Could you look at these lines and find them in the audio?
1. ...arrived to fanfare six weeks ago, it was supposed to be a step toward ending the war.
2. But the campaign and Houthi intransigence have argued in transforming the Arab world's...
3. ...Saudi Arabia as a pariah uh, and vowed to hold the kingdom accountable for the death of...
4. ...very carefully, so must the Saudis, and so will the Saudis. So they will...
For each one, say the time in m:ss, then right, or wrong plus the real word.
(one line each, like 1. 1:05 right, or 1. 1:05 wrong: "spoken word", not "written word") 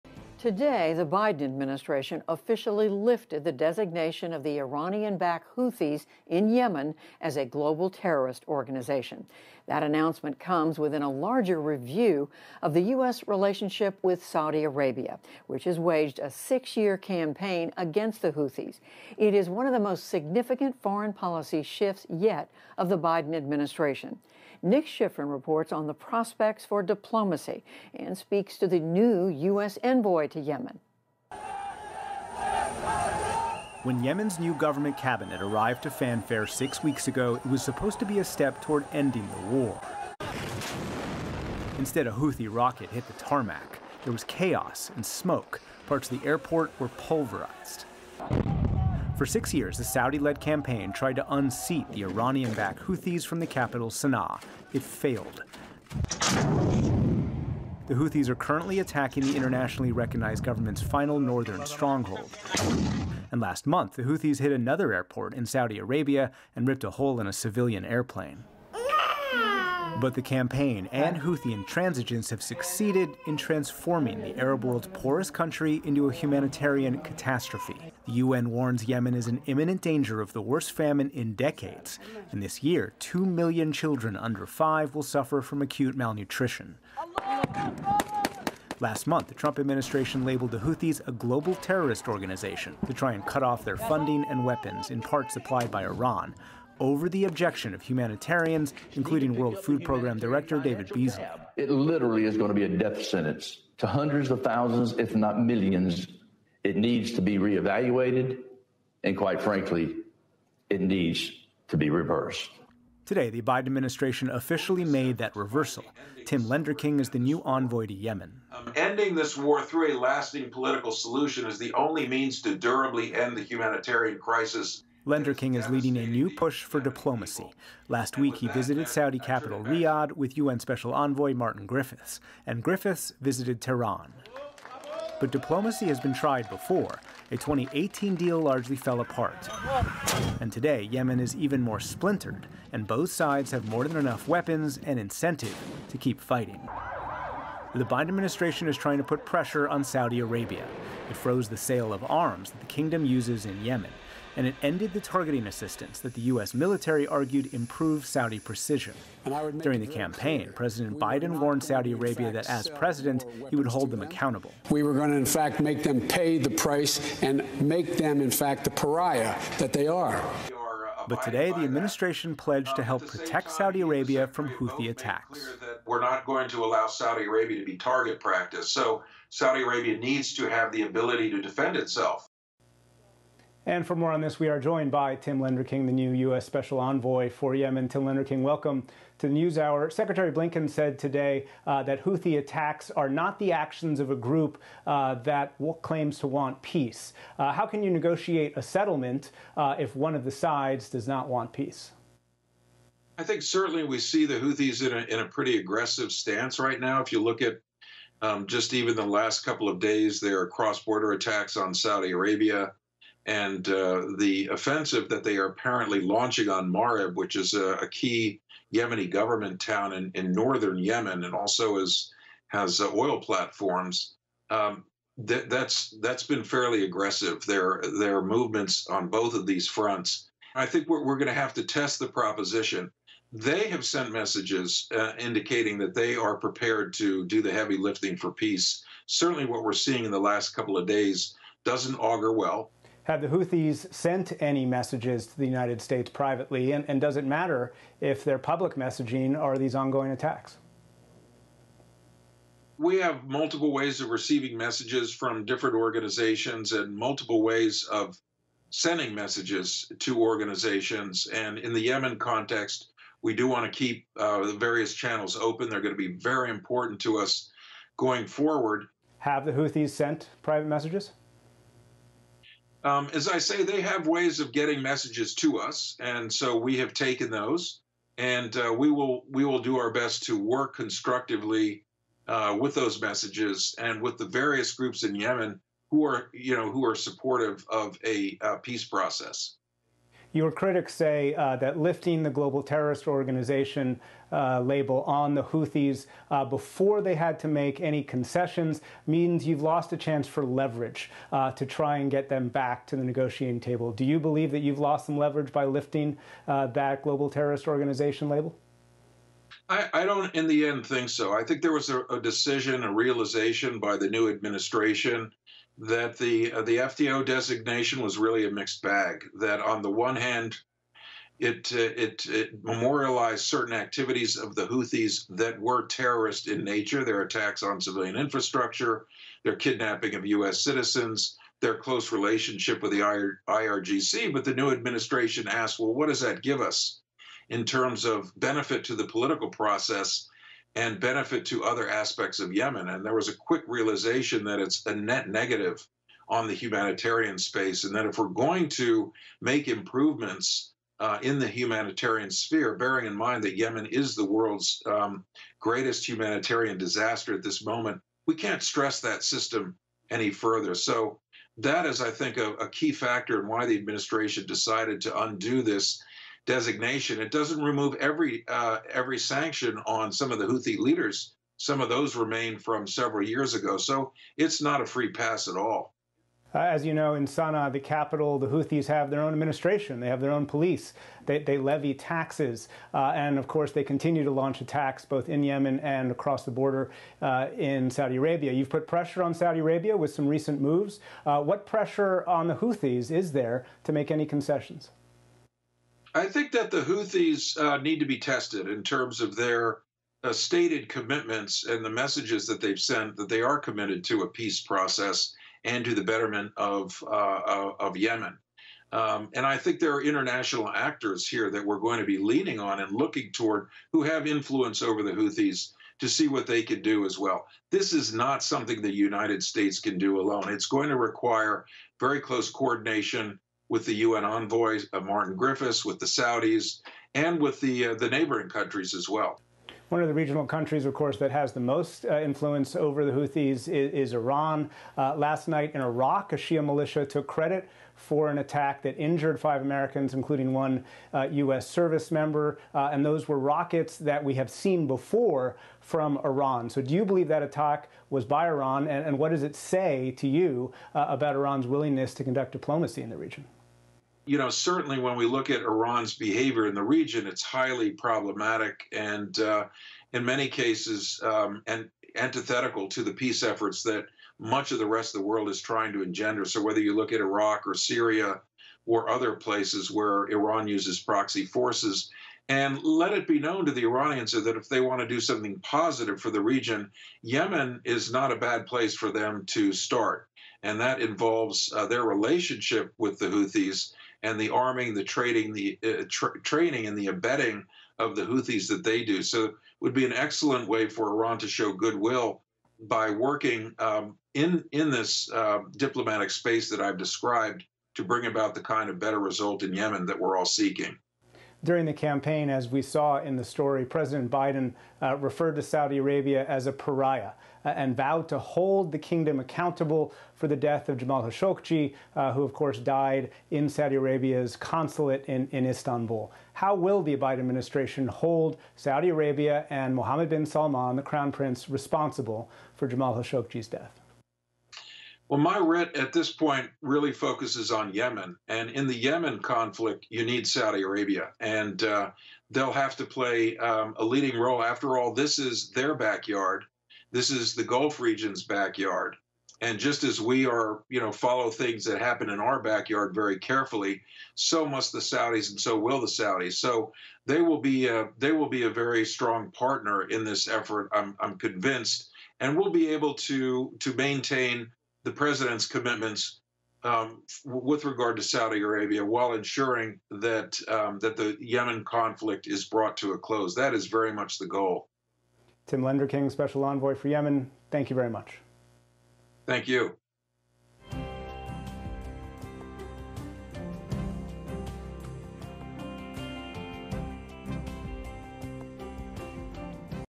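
1. 0:35 right
2. 1:10 wrong: "succeeded", not "argued"
3. 8:25 right
4. 9:03 right.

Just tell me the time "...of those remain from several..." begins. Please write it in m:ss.
6:11.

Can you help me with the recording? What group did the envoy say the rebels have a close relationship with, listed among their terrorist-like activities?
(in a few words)
IRGC.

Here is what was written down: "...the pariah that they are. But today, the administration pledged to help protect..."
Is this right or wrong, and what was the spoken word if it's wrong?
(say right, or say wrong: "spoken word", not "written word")
right.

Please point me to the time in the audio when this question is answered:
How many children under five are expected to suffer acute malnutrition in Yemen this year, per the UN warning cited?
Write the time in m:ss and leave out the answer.
1:22.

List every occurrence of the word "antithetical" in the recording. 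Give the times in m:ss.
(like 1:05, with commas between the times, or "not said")
7:42.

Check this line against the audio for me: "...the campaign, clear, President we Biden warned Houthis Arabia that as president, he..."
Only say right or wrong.
wrong.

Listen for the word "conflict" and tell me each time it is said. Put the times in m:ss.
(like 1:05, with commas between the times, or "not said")
8:49, 9:21.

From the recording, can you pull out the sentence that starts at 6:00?
So that is, I think, a, a key factor in why the administration decided to undo this designation.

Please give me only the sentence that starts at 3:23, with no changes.
I think certainly we see the Houthis in a, in a pretty aggressive stance right now.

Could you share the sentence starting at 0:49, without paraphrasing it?
For six years, the Saudi led campaign tried to unseat the Iranian backed Houthis from the capital, Sana'a.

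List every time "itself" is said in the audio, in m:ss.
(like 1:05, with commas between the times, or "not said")
3:01.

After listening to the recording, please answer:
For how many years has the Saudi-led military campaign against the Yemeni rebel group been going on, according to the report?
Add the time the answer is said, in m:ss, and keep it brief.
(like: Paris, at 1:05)
6, at 0:16.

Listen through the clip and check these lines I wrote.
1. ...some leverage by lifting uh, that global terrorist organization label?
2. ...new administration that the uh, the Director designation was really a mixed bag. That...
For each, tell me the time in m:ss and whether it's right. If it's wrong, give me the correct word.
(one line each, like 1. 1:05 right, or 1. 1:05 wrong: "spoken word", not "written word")
1. 5:05 right
2. 5:14 wrong: "FTO", not "Director".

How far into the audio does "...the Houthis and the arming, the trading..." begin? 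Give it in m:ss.
8:03.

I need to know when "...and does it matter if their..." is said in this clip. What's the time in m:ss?
4:06.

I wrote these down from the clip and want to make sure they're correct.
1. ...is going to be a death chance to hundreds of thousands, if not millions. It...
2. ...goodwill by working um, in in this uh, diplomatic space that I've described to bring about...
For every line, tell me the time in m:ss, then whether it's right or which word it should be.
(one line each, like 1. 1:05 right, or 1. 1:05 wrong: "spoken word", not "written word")
1. 1:42 wrong: "sentence", not "chance"
2. 8:11 right.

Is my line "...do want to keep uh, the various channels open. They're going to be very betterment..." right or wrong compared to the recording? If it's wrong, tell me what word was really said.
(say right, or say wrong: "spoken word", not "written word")
wrong: "important", not "betterment".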